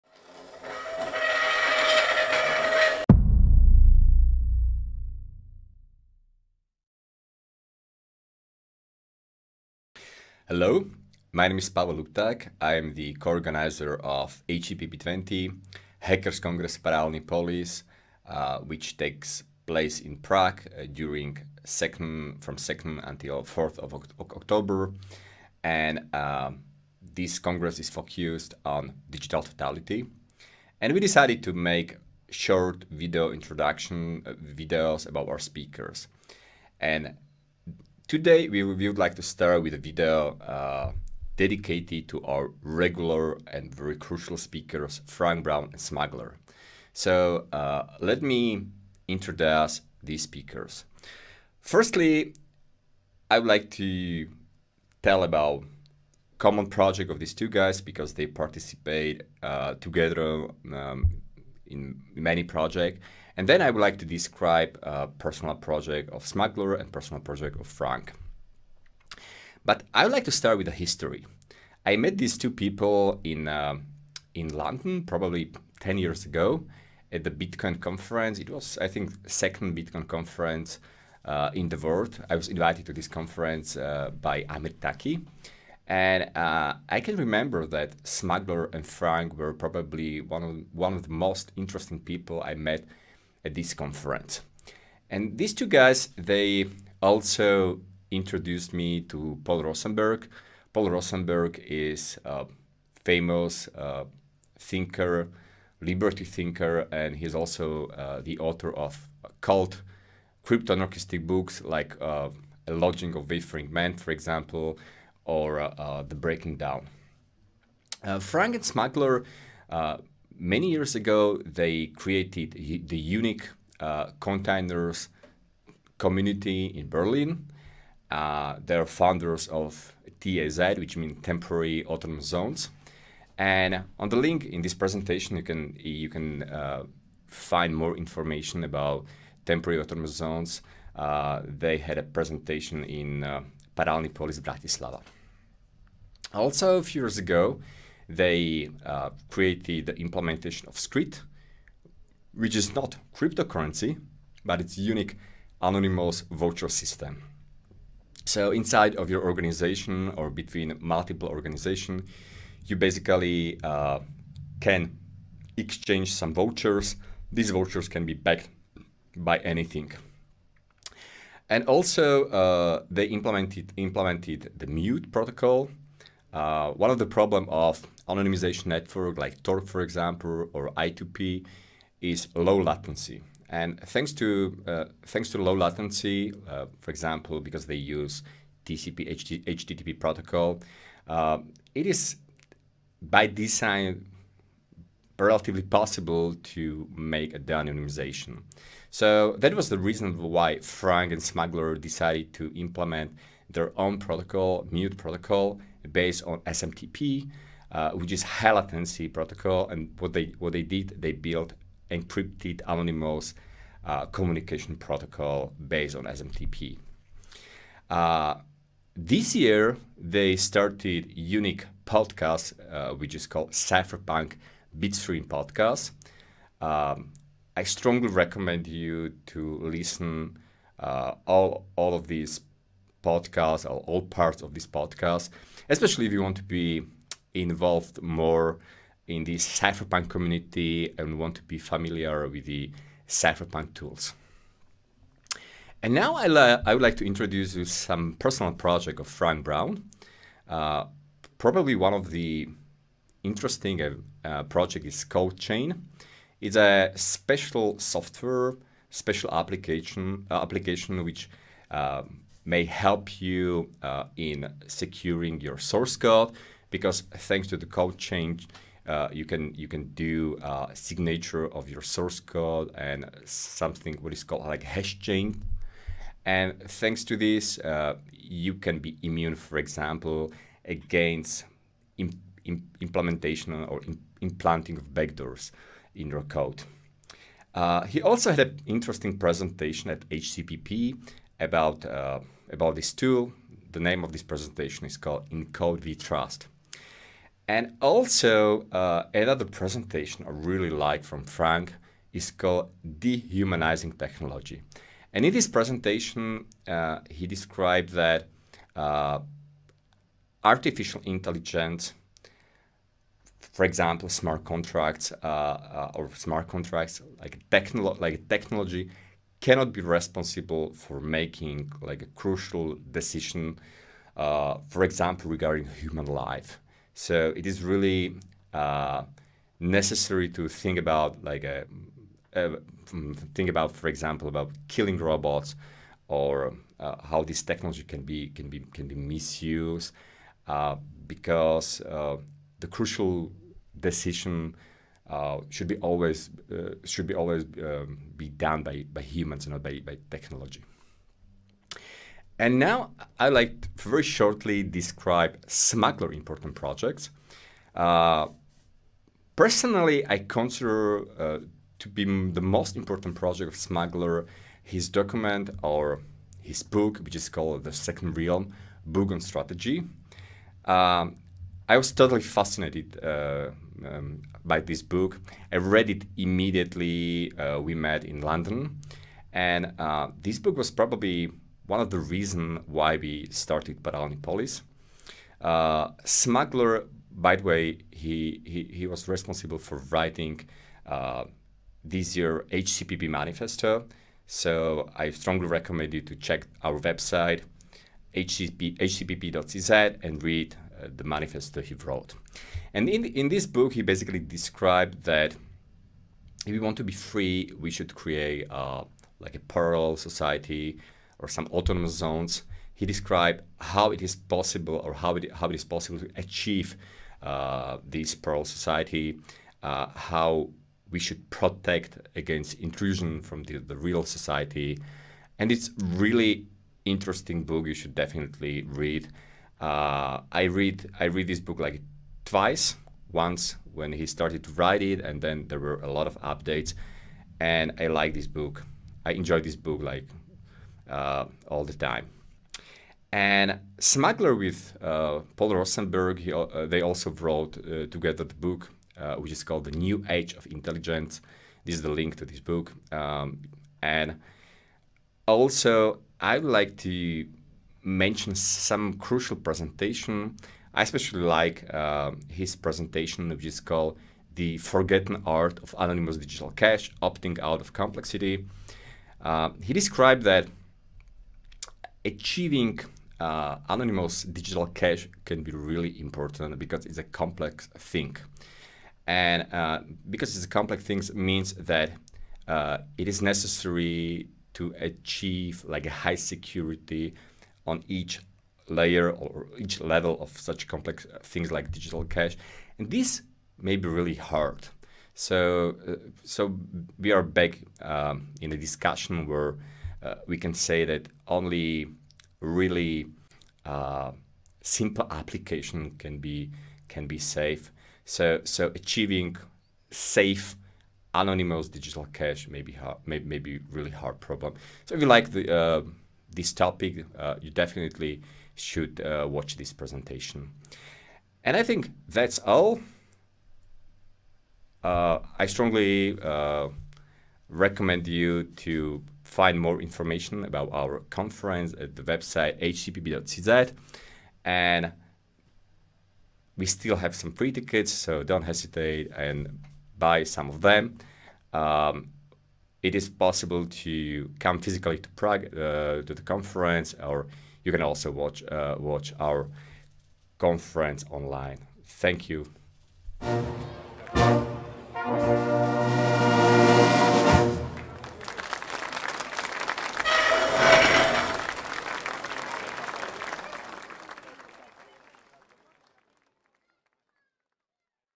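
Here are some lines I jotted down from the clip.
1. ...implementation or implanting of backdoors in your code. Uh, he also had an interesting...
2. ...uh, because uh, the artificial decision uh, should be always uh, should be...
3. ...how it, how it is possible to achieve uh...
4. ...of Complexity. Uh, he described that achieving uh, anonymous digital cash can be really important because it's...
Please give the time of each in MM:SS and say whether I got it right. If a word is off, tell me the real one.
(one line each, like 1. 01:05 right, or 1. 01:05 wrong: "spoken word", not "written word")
1. 04:42 right
2. 05:40 wrong: "crucial", not "artificial"
3. 06:54 right
4. 07:47 right.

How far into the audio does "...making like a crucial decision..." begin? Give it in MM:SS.
05:21.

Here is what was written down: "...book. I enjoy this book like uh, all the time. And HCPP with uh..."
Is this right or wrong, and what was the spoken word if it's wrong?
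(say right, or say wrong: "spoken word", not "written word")
wrong: "Smuggler", not "HCPP".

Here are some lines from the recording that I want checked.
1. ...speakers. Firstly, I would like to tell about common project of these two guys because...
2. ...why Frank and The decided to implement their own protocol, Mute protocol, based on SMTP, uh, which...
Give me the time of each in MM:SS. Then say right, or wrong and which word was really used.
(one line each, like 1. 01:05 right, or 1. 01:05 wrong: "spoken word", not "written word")
1. 00:50 right
2. 03:20 wrong: "Smuggler", not "The".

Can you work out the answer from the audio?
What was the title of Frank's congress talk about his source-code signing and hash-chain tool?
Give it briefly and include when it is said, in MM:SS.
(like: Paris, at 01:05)
In Code We Trust, at 04:55.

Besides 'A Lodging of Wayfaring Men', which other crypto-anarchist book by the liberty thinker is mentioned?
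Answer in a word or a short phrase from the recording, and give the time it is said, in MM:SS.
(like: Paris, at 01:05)
The Breaking Down, at 01:56.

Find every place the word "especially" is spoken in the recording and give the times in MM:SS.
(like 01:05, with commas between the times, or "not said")
03:55, 07:40.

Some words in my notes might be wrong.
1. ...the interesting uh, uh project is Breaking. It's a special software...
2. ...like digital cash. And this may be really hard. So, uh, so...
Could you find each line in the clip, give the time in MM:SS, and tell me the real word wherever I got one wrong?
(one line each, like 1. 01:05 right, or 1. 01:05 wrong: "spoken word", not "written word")
1. 04:12 wrong: "CodeChain", not "Breaking"
2. 08:11 right.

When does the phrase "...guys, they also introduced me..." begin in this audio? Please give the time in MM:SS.
01:35.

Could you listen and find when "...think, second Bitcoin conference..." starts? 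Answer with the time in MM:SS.
01:18.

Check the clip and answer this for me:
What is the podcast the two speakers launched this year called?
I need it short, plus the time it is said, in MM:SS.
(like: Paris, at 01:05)
Cypherpunk Bitstream Podcast, at 03:43.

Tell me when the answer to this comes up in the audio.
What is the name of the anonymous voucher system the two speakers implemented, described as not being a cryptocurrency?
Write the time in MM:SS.
02:30.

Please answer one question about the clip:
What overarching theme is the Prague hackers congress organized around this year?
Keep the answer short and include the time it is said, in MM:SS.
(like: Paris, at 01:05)
Digital totality, at 00:29.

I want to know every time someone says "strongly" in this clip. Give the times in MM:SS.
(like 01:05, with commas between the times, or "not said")
03:47, 06:35, 08:45.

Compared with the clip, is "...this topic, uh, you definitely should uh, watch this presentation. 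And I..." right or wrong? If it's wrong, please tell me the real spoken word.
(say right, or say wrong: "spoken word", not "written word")
right.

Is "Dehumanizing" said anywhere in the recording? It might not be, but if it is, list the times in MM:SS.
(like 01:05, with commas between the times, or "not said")
05:02.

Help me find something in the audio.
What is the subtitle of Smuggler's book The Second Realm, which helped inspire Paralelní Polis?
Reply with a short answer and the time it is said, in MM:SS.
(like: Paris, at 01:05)
Book on Strategy, at 06:08.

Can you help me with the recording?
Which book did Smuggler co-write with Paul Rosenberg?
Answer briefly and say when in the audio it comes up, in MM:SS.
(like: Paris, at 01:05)
The New Age of Intelligence, at 07:29.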